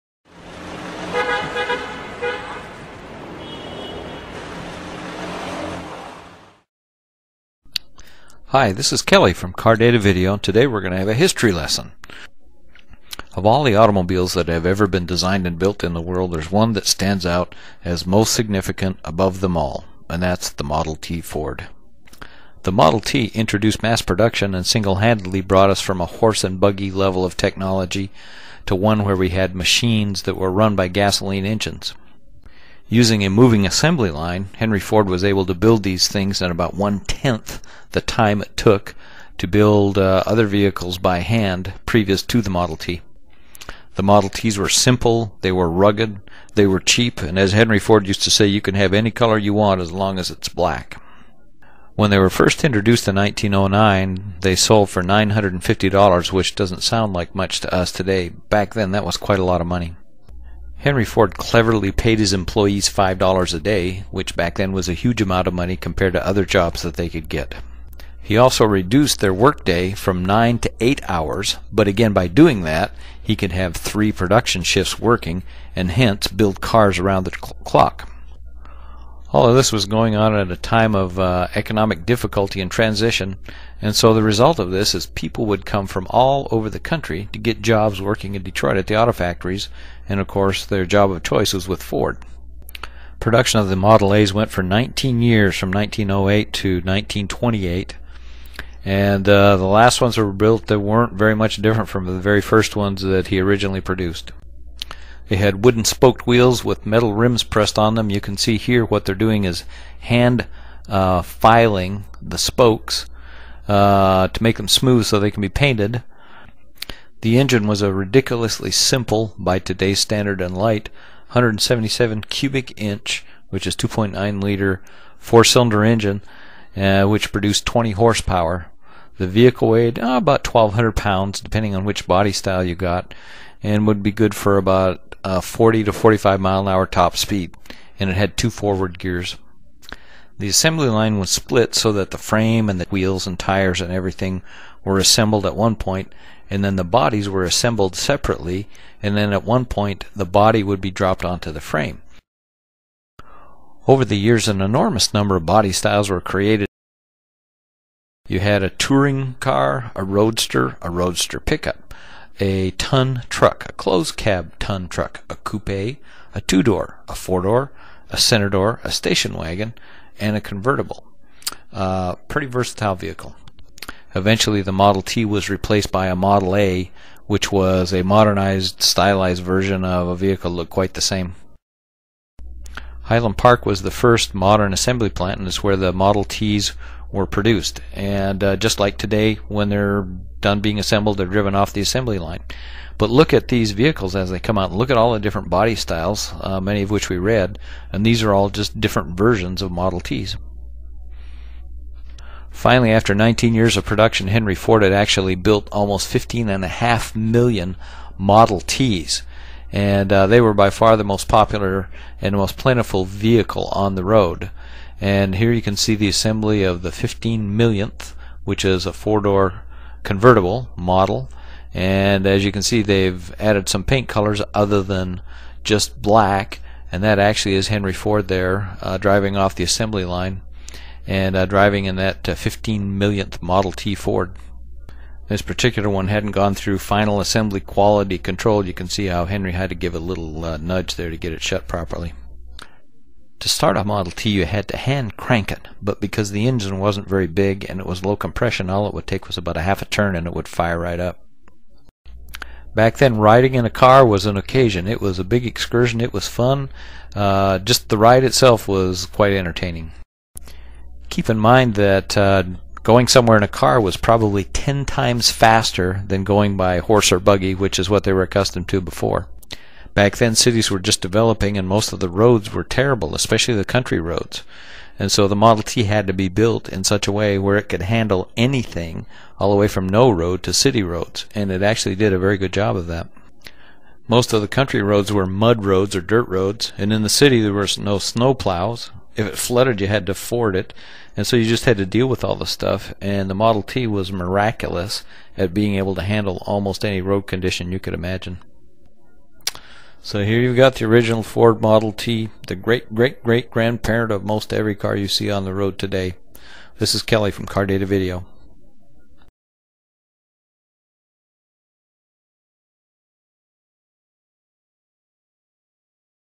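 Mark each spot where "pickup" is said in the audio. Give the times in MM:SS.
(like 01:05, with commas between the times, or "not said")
02:41.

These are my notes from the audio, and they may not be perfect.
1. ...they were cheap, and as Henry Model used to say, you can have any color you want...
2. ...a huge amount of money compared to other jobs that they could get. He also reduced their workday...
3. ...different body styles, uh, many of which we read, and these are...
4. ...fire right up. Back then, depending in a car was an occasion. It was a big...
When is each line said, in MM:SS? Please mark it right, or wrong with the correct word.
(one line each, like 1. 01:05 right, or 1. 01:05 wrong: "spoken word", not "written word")
1. 00:46 wrong: "Ford", not "Model"
2. 01:04 right
3. 03:15 right
4. 04:10 wrong: "riding", not "depending".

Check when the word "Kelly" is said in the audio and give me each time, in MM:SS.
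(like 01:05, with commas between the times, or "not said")
00:09, 05:07.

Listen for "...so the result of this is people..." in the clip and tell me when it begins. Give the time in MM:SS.
01:23.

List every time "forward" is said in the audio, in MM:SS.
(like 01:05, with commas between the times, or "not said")
02:18.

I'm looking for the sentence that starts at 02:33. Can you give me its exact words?
Over the years, an enormous number of body styles were created.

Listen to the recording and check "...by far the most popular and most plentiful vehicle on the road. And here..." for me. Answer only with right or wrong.
right.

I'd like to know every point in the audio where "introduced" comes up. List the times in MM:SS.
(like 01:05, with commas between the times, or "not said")
00:23, 00:52.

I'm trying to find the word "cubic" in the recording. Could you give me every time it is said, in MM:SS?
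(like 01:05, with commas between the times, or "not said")
02:02.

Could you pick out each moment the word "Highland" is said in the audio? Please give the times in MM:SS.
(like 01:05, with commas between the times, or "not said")
03:03.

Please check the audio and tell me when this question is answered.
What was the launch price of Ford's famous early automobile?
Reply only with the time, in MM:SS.
00:55.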